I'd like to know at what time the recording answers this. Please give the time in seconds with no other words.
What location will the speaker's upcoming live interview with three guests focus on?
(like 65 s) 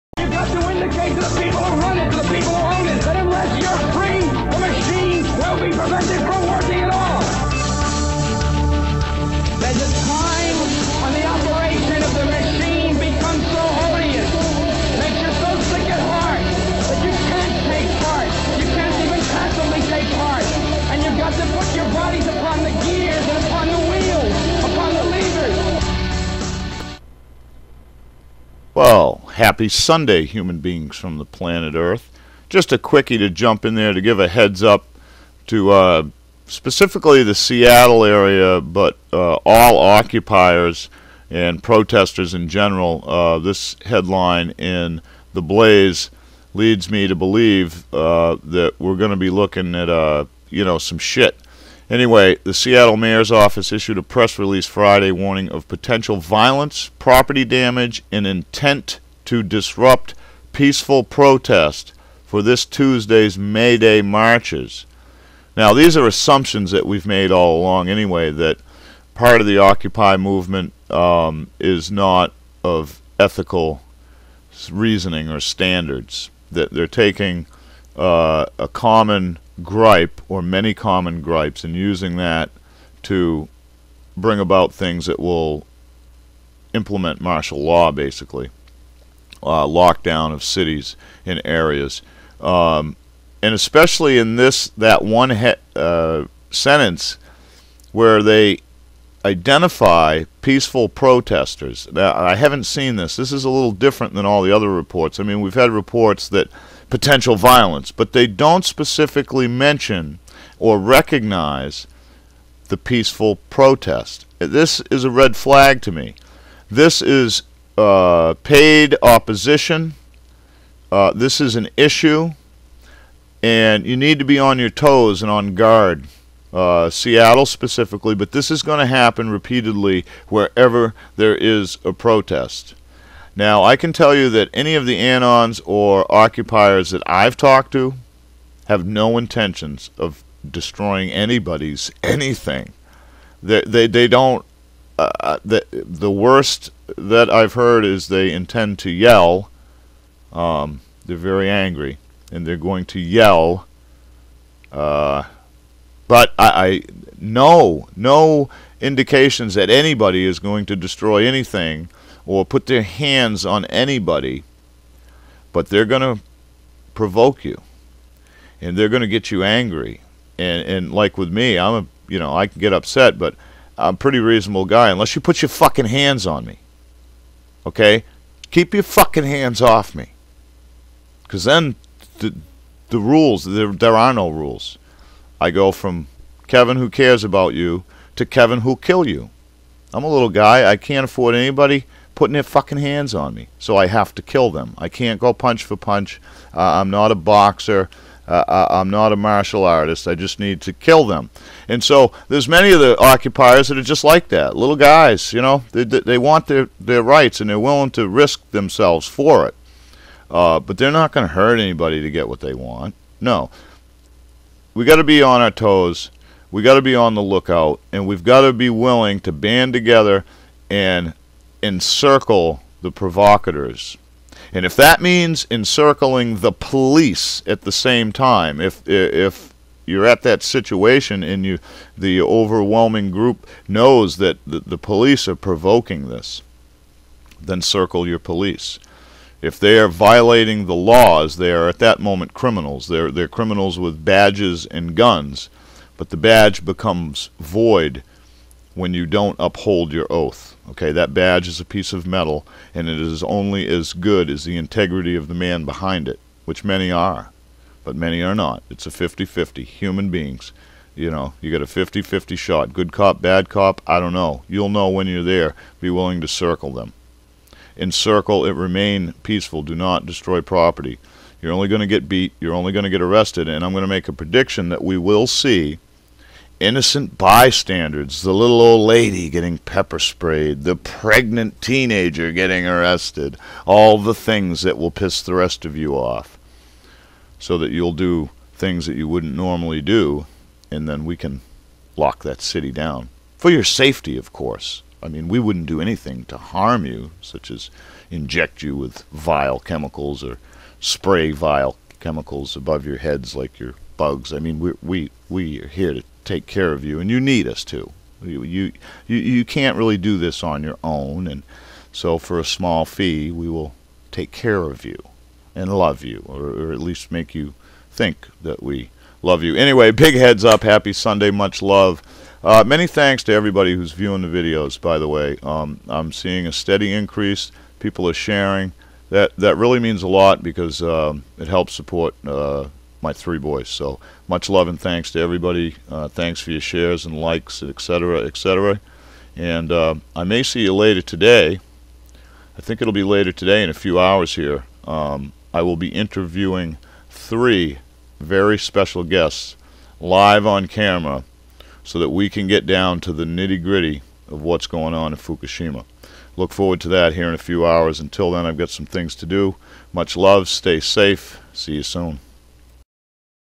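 355 s.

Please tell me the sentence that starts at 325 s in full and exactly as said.
Um, I'm seeing a steady increase.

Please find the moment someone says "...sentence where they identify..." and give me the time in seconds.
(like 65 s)
96 s.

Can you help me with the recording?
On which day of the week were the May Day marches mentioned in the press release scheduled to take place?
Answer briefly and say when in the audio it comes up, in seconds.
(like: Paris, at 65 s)
Tuesday, at 62 s.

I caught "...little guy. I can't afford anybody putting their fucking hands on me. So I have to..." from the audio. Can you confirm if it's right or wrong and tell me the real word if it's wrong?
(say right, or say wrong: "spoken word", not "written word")
right.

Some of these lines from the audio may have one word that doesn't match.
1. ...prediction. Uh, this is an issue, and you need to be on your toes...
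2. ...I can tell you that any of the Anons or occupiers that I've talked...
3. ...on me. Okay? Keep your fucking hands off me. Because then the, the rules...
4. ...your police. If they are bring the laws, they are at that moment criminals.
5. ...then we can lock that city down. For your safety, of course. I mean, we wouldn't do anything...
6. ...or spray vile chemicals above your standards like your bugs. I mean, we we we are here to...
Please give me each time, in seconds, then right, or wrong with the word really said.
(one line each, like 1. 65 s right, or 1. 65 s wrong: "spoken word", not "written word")
1. 119 s wrong: "opposition", not "prediction"
2. 133 s right
3. 176 s right
4. 238 s wrong: "violating", not "bring"
5. 290 s right
6. 300 s wrong: "heads", not "standards".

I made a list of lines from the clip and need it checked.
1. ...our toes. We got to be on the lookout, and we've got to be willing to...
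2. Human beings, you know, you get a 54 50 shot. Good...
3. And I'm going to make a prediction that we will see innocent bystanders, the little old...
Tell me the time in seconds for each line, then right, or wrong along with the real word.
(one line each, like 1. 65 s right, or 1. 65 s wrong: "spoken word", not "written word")
1. 215 s right
2. 259 s wrong: "50", not "54"
3. 273 s right.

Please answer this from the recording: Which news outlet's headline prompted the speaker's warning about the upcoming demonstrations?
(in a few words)
The Blaze.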